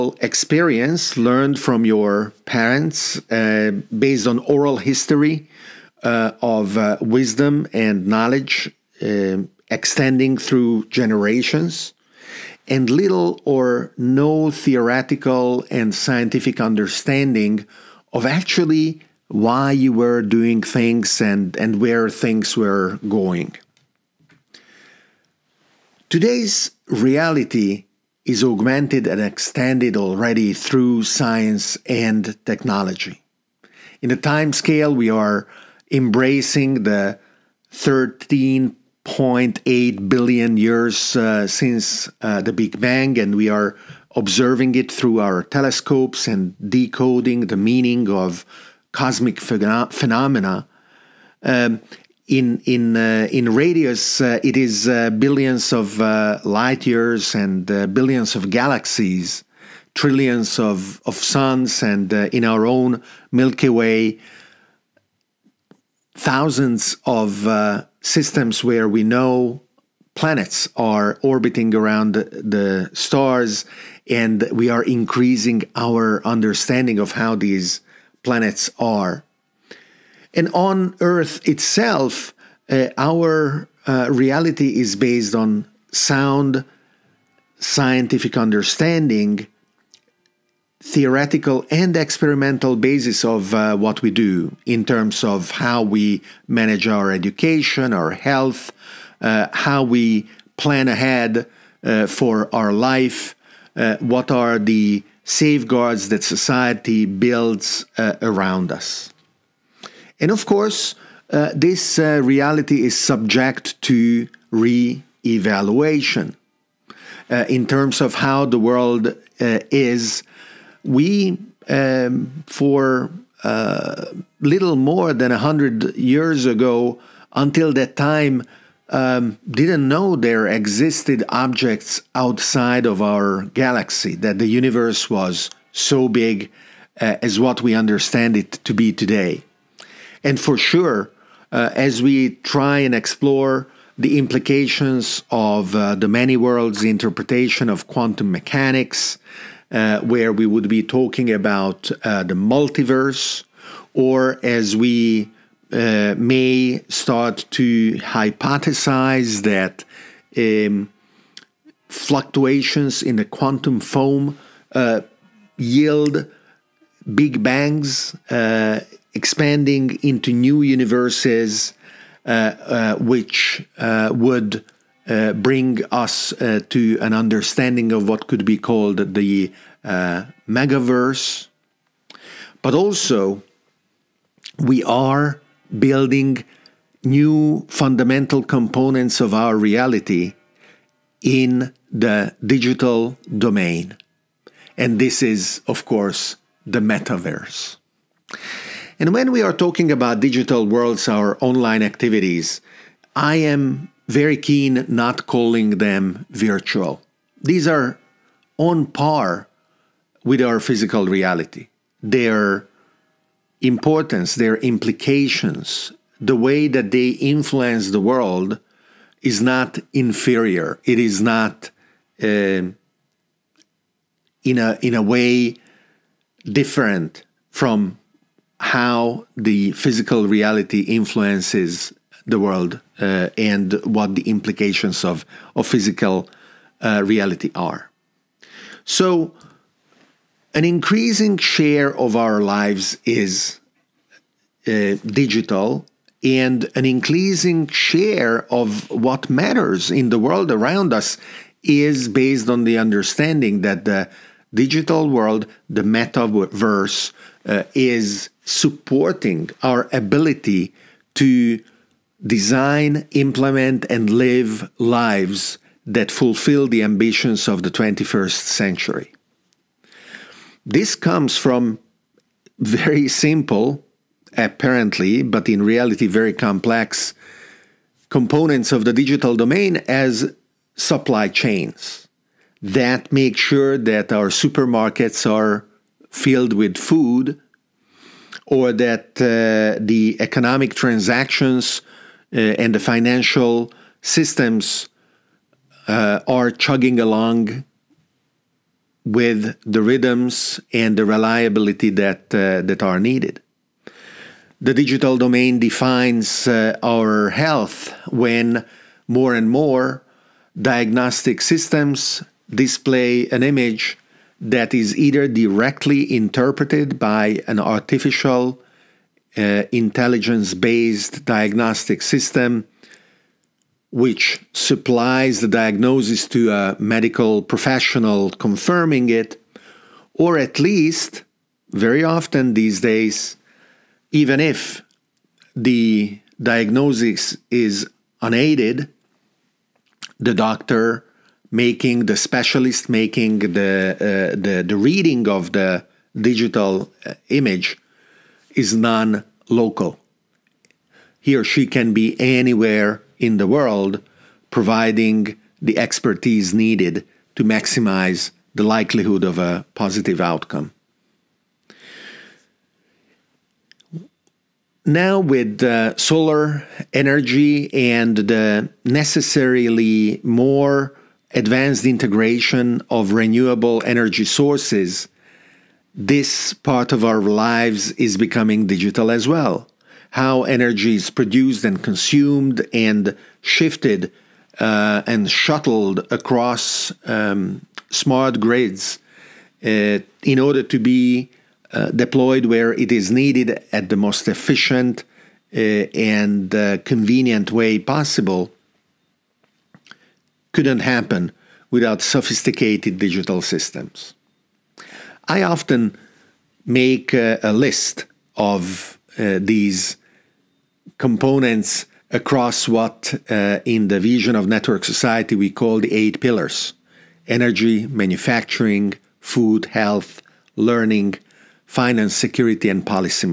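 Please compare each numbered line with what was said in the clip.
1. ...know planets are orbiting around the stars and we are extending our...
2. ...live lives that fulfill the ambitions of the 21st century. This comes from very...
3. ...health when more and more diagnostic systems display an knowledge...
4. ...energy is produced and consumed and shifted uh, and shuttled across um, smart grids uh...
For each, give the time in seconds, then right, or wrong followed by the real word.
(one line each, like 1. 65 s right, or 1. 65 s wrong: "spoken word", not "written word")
1. 69 s wrong: "increasing", not "extending"
2. 264 s right
3. 307 s wrong: "image", not "knowledge"
4. 380 s right.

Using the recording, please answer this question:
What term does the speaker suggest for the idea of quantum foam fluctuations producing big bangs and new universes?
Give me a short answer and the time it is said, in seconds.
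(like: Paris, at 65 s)
megaverse, at 180 s.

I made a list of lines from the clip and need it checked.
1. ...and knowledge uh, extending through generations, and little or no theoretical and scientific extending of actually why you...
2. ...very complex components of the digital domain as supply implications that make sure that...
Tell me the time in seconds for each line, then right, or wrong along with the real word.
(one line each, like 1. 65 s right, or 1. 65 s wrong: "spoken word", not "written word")
1. 7 s wrong: "understanding", not "extending"
2. 276 s wrong: "chains", not "implications".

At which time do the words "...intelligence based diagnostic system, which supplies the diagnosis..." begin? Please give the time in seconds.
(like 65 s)
319 s.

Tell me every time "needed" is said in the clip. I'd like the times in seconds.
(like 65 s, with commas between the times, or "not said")
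302 s, 356 s, 393 s.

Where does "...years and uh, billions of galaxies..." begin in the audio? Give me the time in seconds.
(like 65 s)
56 s.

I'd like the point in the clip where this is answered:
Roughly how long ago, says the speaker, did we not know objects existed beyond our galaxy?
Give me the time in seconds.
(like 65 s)
124 s.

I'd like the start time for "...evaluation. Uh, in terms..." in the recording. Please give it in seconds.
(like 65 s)
115 s.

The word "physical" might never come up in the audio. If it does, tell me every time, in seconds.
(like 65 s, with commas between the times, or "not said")
210 s, 229 s, 235 s.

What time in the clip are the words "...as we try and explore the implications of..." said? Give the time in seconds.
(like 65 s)
141 s.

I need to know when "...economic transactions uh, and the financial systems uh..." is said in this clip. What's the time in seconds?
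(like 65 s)
290 s.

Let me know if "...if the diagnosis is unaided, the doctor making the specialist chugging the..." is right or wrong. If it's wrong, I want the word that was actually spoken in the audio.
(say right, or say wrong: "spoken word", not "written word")
wrong: "making", not "chugging".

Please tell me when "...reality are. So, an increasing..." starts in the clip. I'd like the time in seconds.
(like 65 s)
237 s.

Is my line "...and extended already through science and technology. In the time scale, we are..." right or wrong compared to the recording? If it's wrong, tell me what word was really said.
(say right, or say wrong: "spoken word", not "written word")
right.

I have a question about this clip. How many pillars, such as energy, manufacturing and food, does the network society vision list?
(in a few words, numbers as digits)
8.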